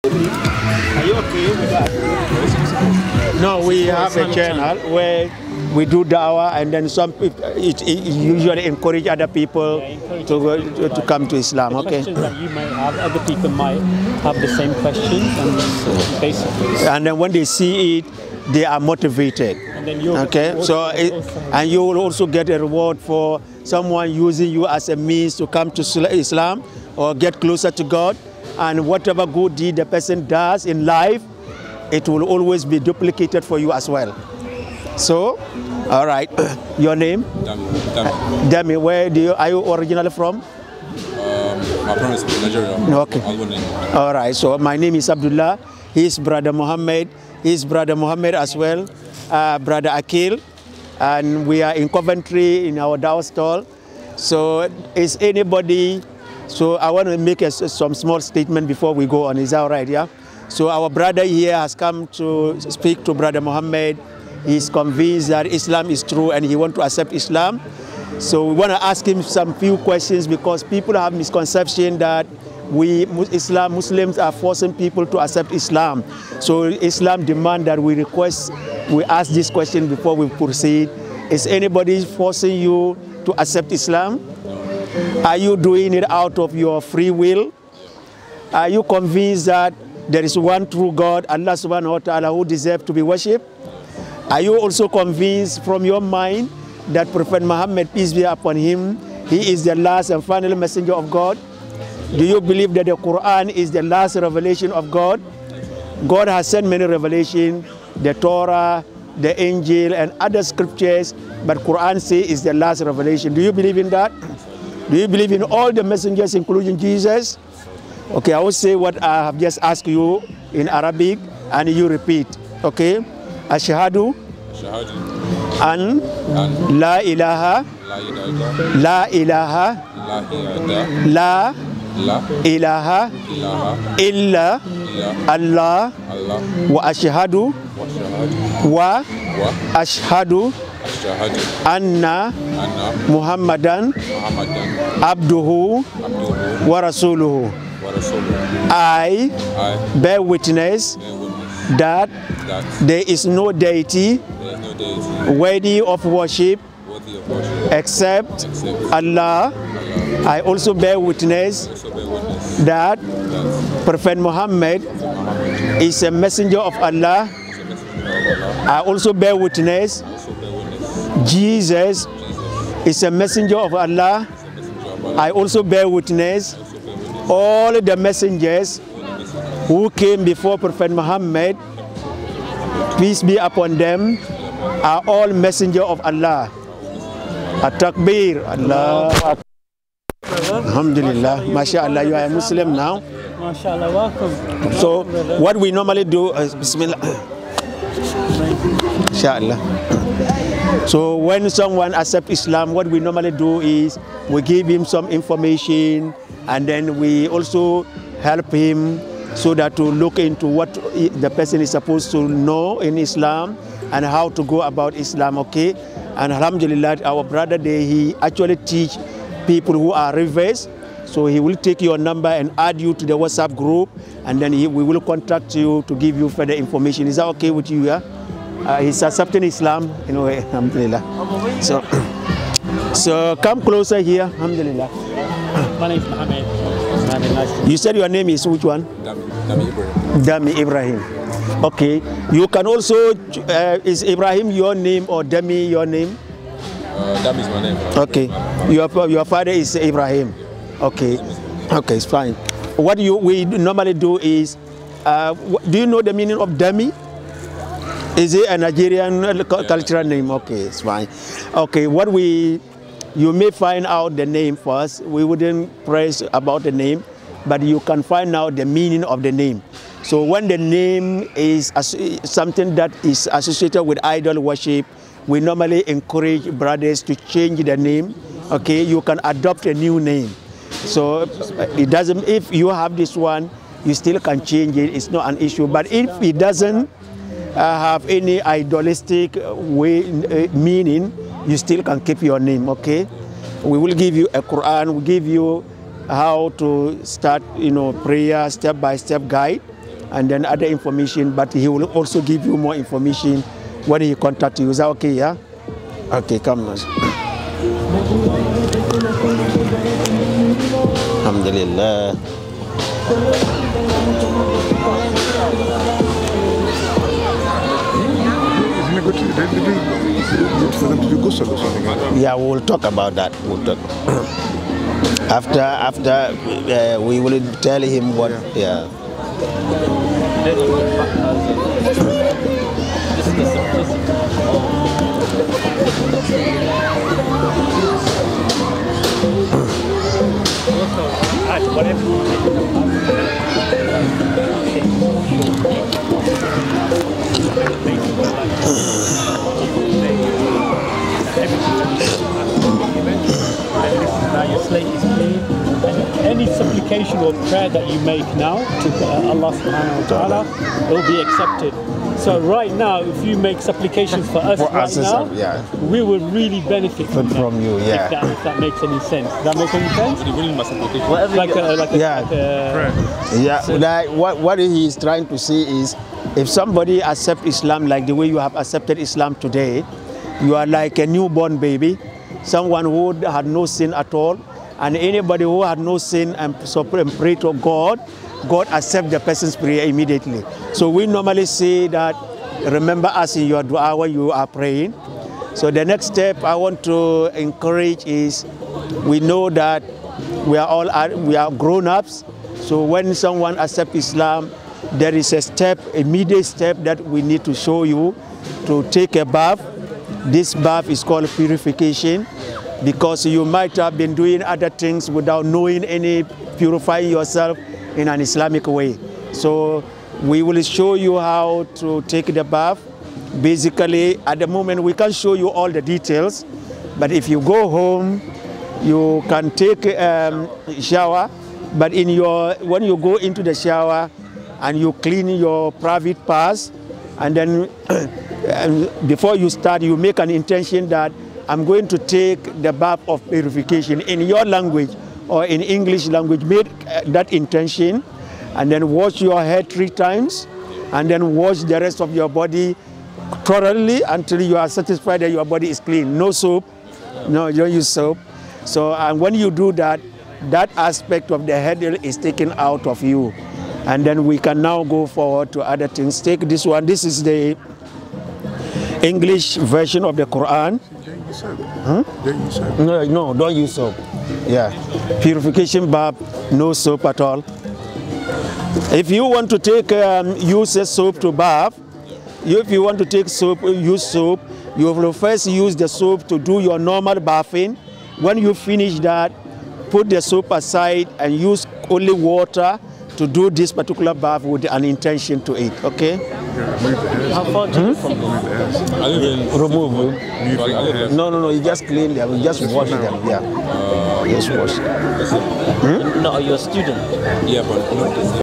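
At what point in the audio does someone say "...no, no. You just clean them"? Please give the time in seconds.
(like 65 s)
501 s.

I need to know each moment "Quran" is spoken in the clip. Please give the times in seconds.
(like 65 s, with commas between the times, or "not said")
102 s, 111 s, 294 s, 470 s.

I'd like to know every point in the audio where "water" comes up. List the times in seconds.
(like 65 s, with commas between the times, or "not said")
492 s.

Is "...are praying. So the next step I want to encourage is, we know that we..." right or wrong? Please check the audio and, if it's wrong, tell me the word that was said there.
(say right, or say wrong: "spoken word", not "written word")
right.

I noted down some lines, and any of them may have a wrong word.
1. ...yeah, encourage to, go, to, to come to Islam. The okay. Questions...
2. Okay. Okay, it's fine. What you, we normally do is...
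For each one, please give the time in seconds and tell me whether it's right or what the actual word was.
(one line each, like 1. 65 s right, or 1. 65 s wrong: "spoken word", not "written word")
1. 9 s right
2. 250 s right.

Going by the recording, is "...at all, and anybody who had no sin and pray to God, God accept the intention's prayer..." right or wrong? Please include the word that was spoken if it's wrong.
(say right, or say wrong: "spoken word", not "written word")
wrong: "person", not "intention".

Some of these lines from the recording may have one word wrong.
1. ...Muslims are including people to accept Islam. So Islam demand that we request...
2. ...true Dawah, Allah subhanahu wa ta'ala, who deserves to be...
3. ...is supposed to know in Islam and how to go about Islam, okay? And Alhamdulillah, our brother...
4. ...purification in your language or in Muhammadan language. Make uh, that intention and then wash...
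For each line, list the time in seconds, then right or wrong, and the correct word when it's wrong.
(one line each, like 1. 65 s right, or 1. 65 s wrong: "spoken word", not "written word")
1. 73 s wrong: "forcing", not "including"
2. 90 s wrong: "God", not "Dawah"
3. 211 s right
4. 443 s wrong: "English", not "Muhammadan".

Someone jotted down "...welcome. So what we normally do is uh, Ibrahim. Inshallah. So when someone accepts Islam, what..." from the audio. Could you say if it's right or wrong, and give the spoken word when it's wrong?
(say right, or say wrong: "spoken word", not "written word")
wrong: "Bismillah", not "Ibrahim".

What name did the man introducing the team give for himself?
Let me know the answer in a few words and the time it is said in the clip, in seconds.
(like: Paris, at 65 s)
Abdullah, at 45 s.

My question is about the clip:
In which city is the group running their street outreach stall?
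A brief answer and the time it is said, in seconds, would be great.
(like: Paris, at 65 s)
Coventry, at 51 s.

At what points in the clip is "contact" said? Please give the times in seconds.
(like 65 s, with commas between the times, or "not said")
225 s, 304 s.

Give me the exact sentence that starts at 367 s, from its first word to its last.
Yeah, if that, if that, makes any sense.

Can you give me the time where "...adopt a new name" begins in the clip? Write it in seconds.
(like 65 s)
279 s.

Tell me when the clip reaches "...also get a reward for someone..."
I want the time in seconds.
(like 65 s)
21 s.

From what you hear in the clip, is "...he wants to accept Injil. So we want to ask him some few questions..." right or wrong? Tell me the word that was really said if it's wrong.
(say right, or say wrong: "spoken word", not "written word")
wrong: "Islam", not "Injil".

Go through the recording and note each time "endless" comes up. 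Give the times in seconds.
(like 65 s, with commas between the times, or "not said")
not said.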